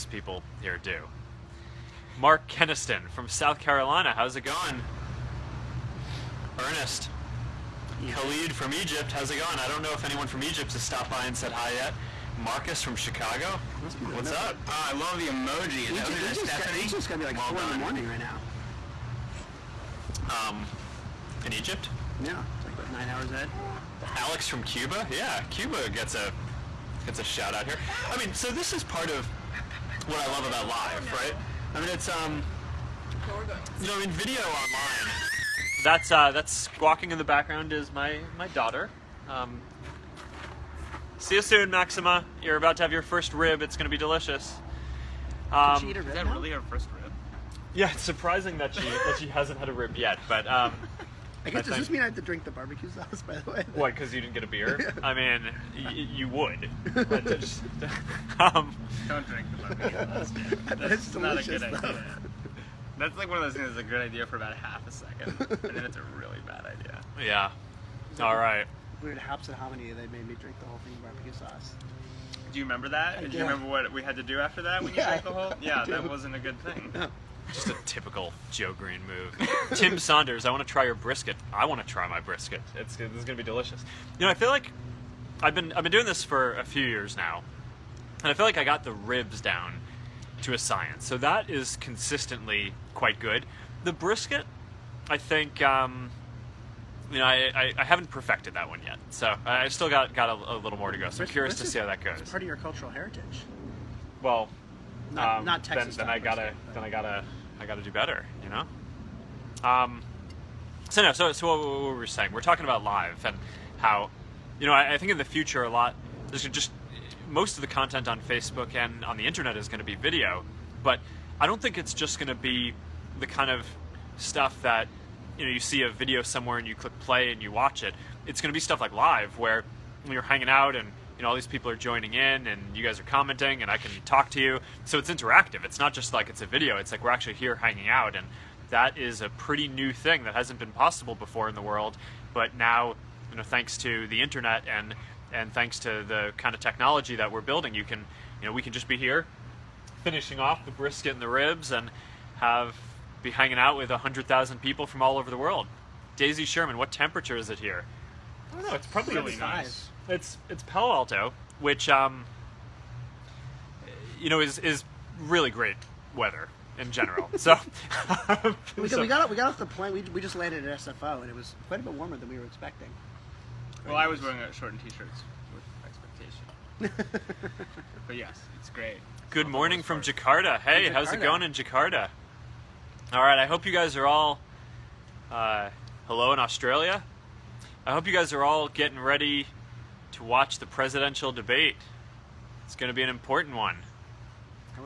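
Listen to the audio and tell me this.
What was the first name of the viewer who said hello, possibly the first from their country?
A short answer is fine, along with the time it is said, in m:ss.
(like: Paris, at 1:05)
Khalid, at 0:08.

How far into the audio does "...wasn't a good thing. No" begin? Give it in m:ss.
1:16.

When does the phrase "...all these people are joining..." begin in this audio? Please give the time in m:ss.
2:11.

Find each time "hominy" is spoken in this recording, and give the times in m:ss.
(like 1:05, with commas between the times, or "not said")
1:09.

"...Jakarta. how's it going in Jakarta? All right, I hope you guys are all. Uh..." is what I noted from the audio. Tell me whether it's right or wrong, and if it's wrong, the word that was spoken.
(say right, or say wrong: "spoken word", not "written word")
right.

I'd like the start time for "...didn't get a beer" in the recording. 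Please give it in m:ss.
0:54.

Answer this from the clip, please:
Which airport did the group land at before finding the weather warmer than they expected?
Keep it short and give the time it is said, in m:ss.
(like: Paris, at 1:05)
SFO, at 2:50.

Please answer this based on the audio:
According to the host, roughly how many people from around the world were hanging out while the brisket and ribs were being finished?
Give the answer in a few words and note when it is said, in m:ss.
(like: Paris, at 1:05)
100,000, at 2:33.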